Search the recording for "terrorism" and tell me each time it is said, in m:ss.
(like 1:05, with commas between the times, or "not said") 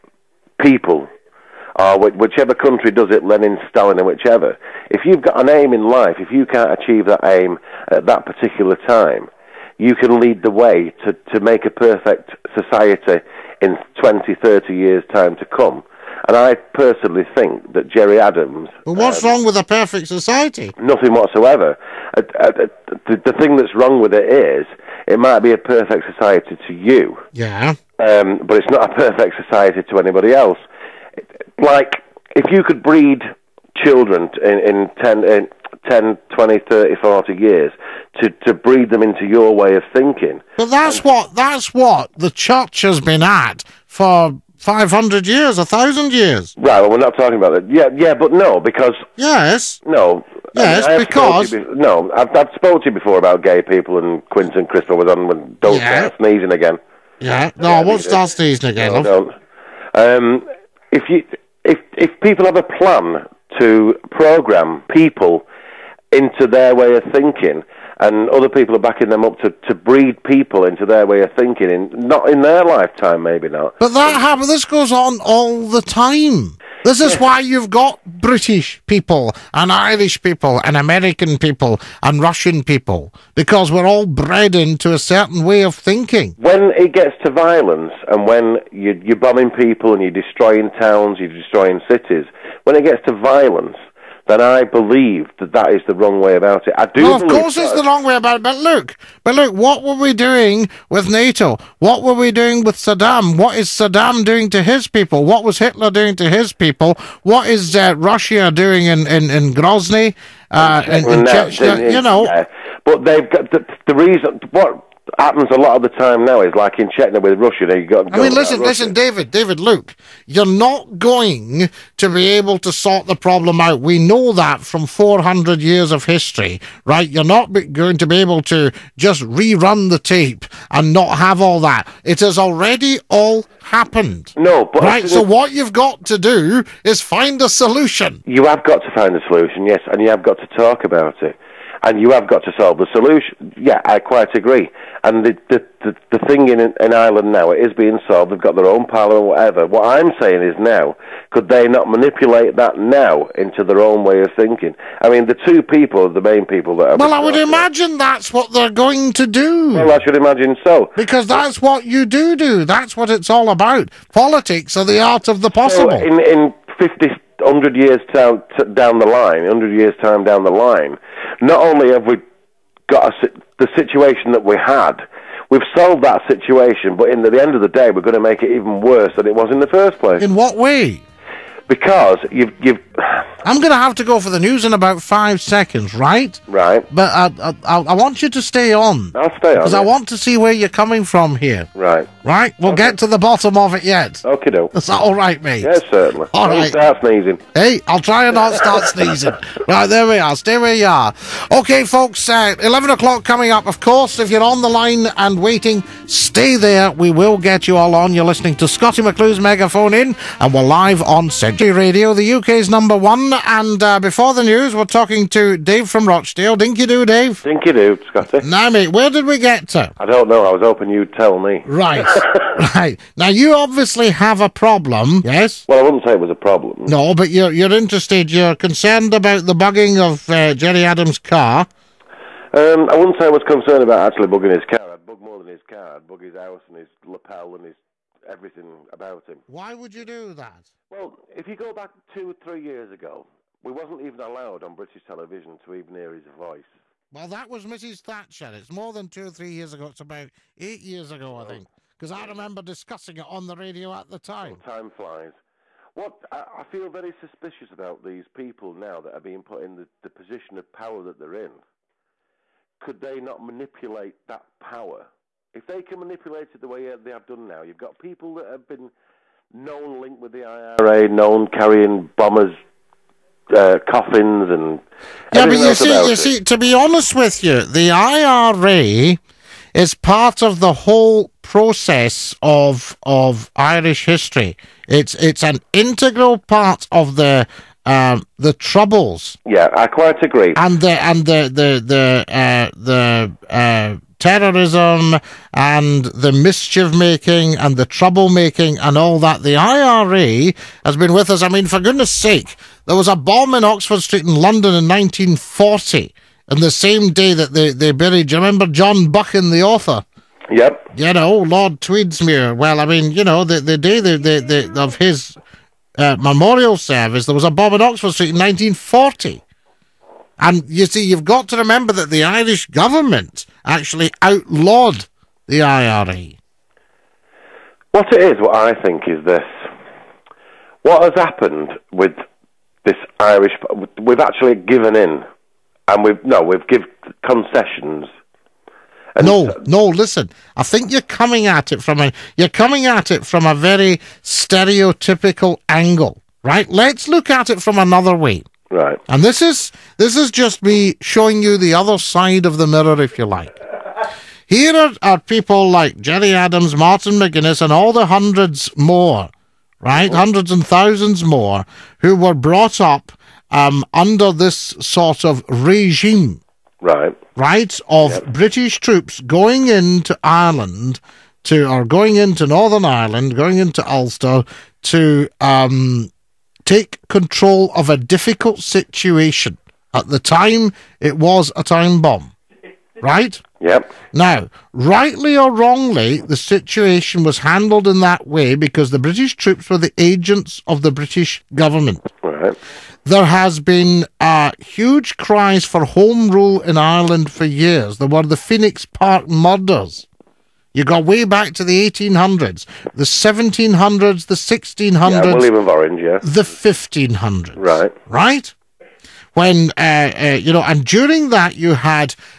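4:54.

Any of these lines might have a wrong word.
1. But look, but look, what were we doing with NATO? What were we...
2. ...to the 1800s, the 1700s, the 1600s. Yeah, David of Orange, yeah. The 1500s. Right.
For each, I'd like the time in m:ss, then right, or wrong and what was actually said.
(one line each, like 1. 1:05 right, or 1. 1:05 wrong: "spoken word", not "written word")
1. 1:38 right
2. 6:41 wrong: "William", not "David".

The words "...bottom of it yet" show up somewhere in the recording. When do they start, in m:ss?
3:13.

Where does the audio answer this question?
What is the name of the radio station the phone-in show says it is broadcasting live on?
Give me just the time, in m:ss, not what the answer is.
3:31.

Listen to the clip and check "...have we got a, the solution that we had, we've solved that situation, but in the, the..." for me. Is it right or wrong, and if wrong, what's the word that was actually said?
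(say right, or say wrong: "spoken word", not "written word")
wrong: "situation", not "solution".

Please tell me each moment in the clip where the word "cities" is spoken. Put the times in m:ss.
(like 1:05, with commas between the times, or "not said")
1:31.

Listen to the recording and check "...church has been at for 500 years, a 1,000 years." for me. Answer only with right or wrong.
right.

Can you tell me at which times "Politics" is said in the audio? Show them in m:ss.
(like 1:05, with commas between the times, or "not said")
2:44.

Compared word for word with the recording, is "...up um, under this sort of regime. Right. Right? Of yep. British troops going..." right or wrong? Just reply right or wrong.
right.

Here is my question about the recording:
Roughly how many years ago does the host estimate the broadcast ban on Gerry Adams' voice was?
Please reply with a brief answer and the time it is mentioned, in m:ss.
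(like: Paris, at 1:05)
8, at 4:10.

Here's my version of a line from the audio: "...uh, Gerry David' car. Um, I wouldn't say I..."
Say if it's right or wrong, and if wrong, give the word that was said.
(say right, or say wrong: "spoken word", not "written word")
wrong: "Adams", not "David".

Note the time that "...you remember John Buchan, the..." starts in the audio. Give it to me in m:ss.
5:08.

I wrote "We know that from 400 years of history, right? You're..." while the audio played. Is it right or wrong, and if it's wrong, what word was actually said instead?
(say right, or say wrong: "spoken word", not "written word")
right.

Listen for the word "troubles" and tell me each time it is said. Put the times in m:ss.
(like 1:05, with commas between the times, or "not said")
4:48, 4:57.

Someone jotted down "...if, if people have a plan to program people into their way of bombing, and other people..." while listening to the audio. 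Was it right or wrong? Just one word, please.
wrong.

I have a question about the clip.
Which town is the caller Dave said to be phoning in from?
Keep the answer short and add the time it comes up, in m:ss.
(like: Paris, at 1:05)
Rochdale, at 3:36.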